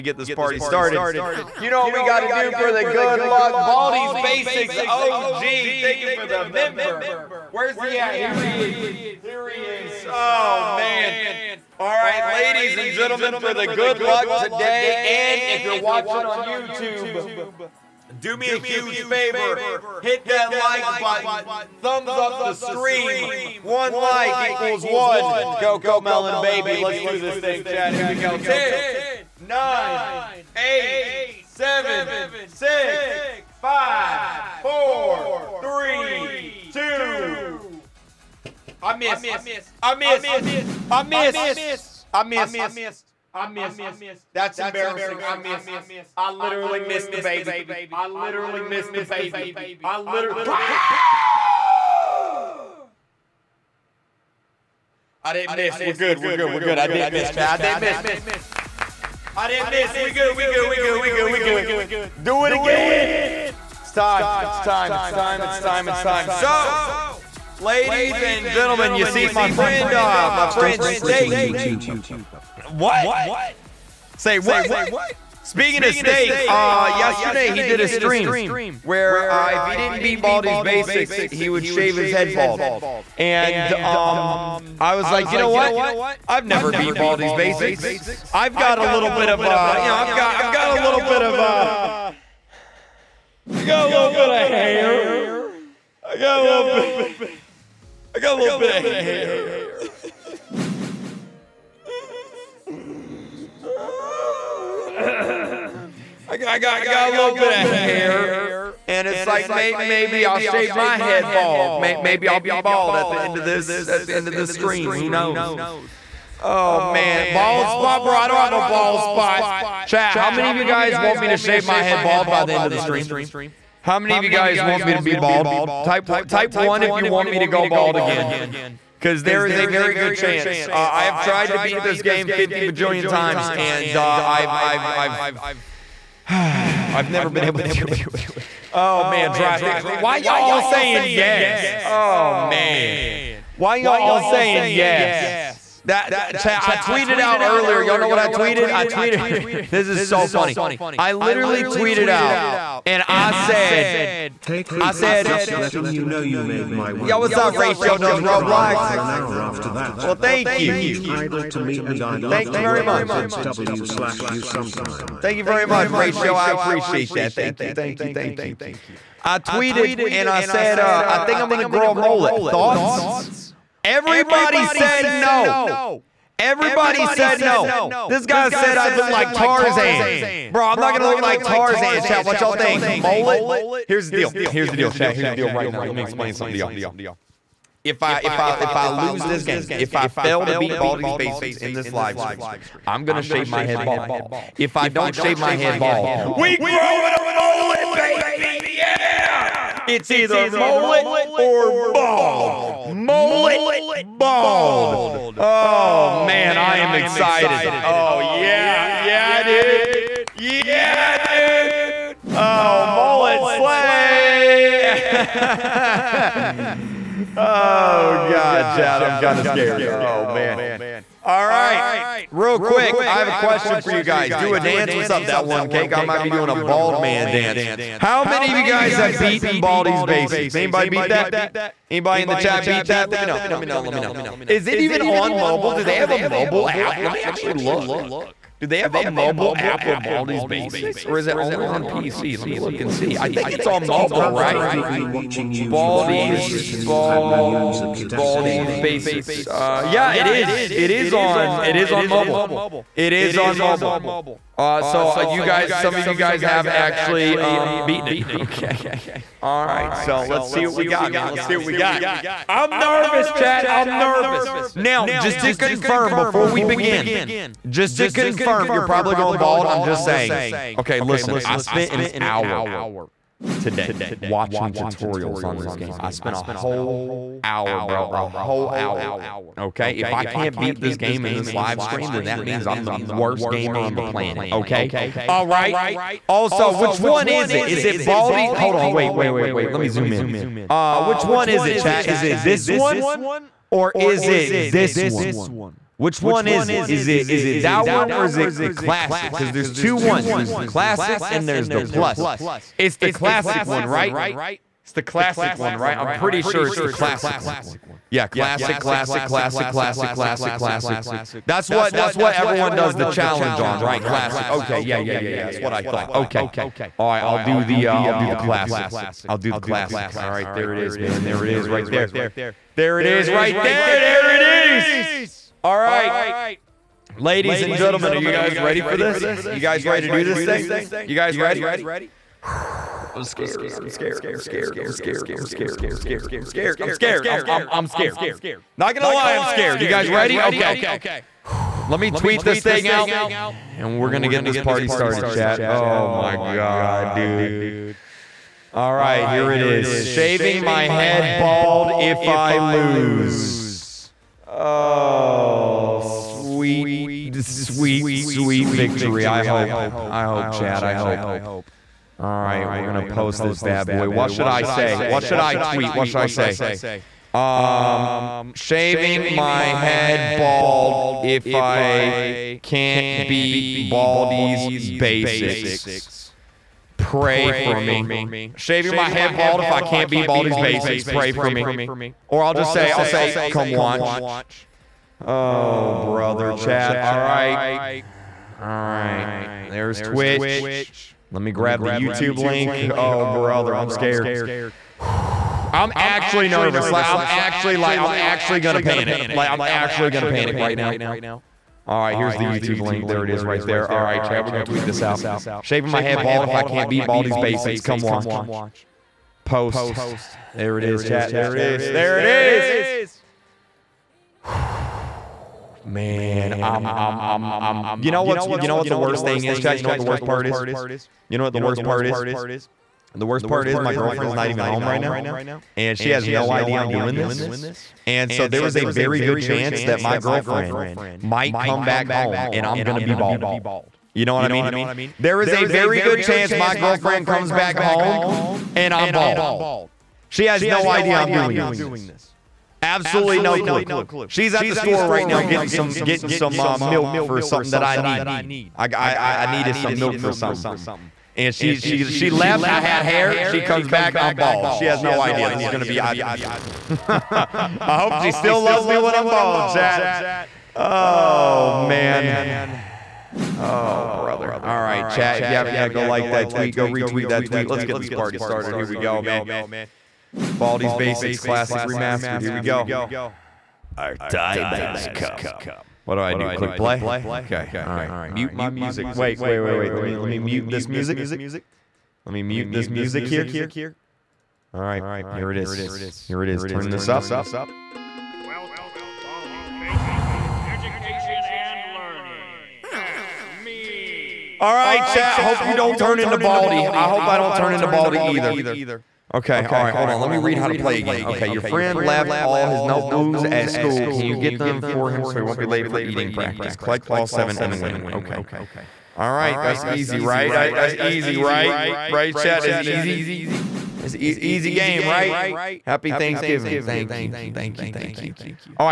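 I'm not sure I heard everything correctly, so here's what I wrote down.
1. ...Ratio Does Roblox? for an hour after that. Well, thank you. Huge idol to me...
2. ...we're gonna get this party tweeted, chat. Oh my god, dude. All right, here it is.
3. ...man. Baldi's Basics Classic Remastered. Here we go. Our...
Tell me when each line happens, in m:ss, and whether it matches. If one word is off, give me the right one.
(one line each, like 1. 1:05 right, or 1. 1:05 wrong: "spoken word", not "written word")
1. 2:37 right
2. 5:43 wrong: "started", not "tweeted"
3. 7:49 right.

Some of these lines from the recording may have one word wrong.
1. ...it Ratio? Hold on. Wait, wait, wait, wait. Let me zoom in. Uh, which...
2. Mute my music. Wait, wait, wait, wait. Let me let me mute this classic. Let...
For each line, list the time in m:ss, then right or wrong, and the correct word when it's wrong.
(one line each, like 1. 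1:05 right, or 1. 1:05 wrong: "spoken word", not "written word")
1. 4:47 wrong: "Baldi", not "Ratio"
2. 7:58 wrong: "music", not "classic".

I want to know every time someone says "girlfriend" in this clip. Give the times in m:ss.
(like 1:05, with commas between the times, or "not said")
7:03, 7:10, 7:16.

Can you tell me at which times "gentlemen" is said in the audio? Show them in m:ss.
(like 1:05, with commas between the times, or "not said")
0:12, 1:08, 5:27.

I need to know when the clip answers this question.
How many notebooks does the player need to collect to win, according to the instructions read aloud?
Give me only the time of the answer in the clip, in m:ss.
8:26.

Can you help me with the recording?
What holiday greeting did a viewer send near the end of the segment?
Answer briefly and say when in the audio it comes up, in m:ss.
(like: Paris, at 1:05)
Happy Thanksgiving, at 8:35.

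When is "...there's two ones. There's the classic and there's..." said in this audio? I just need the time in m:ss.
4:59.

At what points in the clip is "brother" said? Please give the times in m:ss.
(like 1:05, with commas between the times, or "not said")
6:25, 6:33, 7:44.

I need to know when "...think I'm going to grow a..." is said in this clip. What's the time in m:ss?
2:51.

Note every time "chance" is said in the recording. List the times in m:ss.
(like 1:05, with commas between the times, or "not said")
2:10, 7:09, 7:16.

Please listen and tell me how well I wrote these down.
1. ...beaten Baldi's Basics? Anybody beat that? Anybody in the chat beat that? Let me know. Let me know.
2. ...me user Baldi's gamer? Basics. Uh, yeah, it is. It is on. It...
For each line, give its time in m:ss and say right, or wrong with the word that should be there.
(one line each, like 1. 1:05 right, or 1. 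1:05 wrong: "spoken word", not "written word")
1. 3:49 right
2. 4:07 right.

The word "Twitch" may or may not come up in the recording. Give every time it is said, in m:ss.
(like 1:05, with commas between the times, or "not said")
6:30.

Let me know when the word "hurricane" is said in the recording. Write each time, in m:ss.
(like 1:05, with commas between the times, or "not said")
not said.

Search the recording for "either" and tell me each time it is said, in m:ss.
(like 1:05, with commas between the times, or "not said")
3:20, 8:18.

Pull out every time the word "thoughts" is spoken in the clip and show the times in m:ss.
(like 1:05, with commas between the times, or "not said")
2:52, 5:15.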